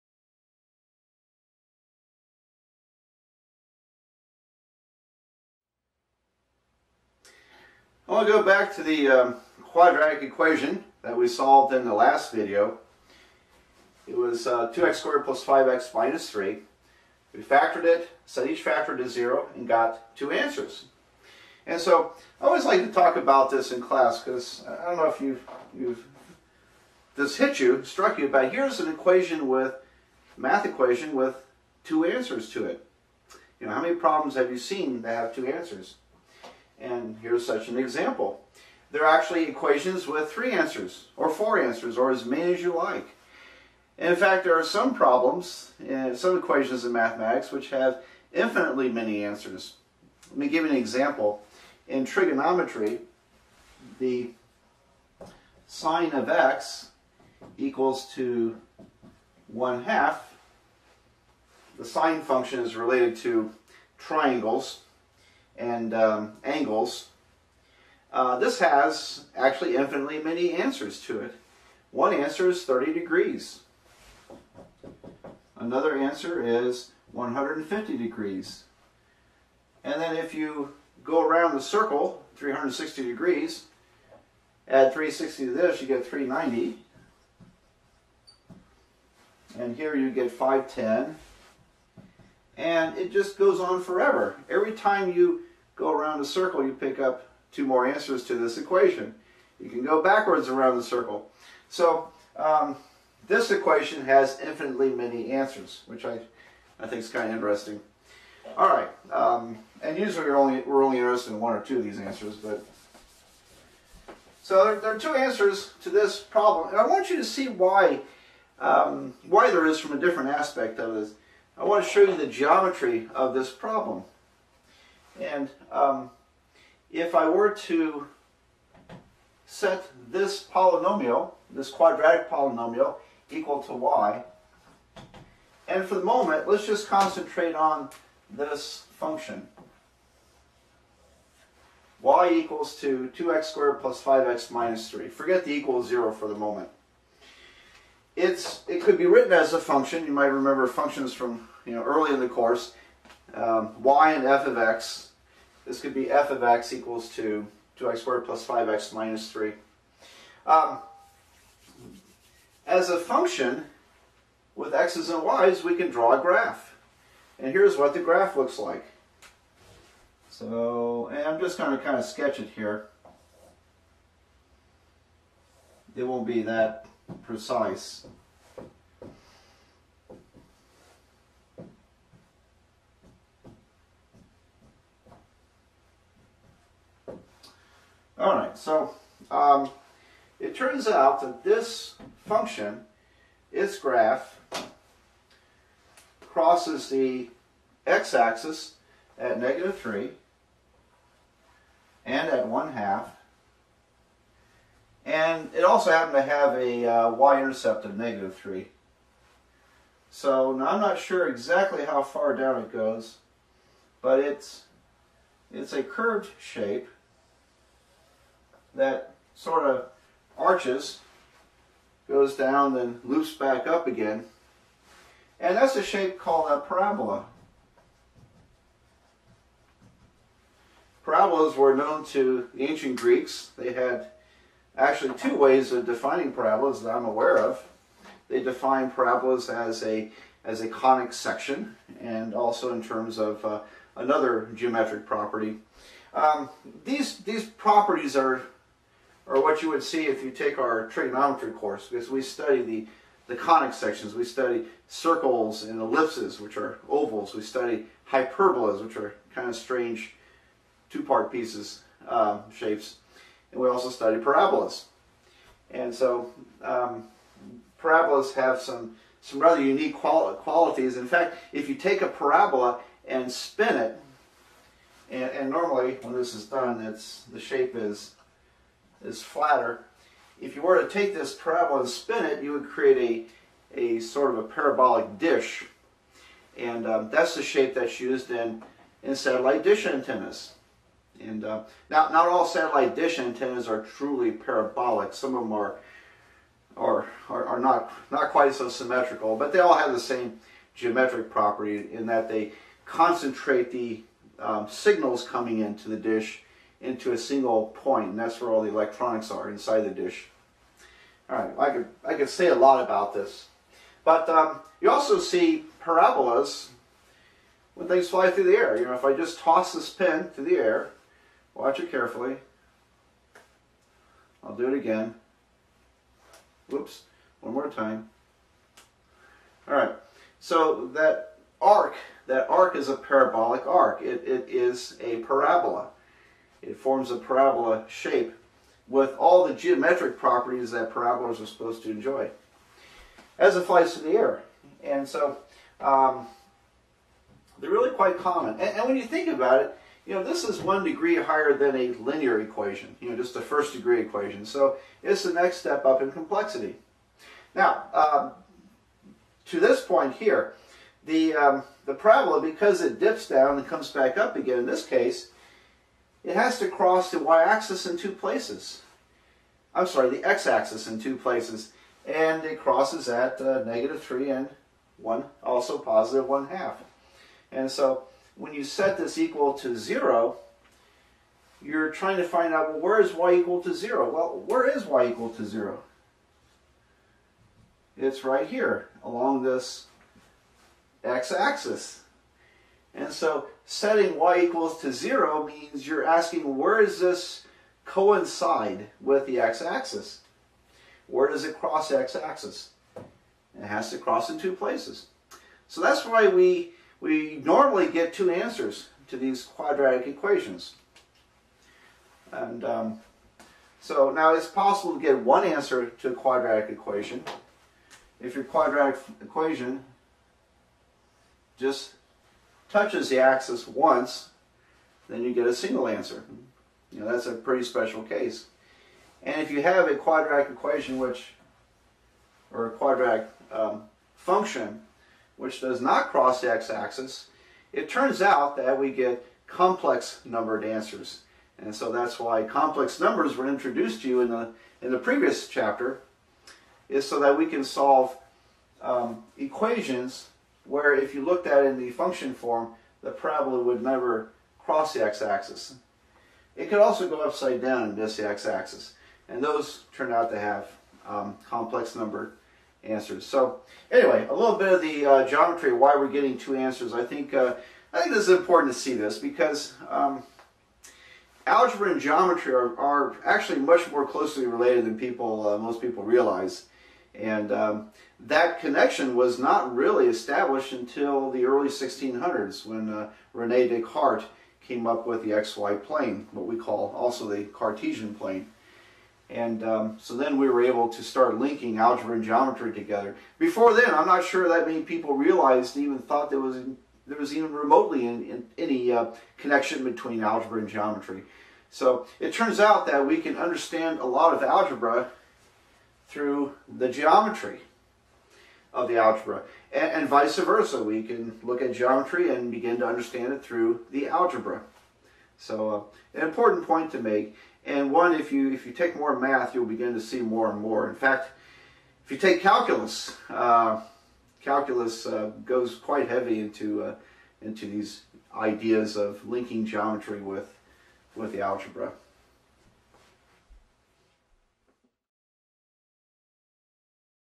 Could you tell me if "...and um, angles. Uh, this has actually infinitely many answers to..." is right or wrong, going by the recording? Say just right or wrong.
right.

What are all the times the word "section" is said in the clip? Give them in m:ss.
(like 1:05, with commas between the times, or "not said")
4:01, 4:13.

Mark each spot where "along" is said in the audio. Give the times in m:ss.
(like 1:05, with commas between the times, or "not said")
6:29.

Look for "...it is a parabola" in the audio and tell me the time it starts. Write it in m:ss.
5:34.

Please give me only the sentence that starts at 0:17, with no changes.
We factored it, set each factor to 0, and got two answers.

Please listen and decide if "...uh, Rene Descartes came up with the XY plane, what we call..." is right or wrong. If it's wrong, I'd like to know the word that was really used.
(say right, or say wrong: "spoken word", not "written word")
right.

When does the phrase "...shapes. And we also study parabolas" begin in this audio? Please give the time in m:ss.
4:22.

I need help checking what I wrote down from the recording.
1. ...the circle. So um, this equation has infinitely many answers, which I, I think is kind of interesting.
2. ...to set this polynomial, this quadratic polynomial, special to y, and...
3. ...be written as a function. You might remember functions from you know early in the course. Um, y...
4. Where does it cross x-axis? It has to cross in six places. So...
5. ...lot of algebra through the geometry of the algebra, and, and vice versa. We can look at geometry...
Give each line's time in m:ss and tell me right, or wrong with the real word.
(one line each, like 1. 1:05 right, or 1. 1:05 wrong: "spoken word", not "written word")
1. 1:40 right
2. 2:07 wrong: "equal", not "special"
3. 2:28 right
4. 6:41 wrong: "two", not "six"
5. 8:24 right.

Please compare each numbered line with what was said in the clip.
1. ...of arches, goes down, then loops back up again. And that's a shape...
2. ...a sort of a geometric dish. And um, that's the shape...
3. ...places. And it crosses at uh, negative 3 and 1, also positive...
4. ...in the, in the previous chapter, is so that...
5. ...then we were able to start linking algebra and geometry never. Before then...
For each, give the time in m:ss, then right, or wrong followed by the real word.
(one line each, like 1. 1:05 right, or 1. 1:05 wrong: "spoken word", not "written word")
1. 3:39 right
2. 4:43 wrong: "parabolic", not "geometric"
3. 6:11 right
4. 7:24 right
5. 8:10 wrong: "together", not "never".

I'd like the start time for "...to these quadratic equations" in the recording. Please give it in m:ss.
6:49.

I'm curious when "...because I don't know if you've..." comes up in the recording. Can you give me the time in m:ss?
0:24.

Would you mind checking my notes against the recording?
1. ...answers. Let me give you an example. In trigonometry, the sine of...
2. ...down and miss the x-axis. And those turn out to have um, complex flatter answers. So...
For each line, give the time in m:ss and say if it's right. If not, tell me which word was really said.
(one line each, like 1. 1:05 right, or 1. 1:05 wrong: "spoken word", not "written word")
1. 0:49 right
2. 7:37 wrong: "number", not "flatter".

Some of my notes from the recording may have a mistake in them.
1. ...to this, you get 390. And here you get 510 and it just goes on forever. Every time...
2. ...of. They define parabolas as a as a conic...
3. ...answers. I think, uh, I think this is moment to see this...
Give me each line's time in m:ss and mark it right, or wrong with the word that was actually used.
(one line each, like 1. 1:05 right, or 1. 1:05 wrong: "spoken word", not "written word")
1. 1:25 right
2. 3:57 right
3. 7:46 wrong: "important", not "moment".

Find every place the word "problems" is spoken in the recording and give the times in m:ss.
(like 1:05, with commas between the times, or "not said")
0:33, 0:44, 1:56, 2:03.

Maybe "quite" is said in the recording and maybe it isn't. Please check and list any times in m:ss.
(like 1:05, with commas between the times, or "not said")
4:58, 5:47, 8:45.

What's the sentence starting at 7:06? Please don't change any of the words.
You know, that's a pretty special case.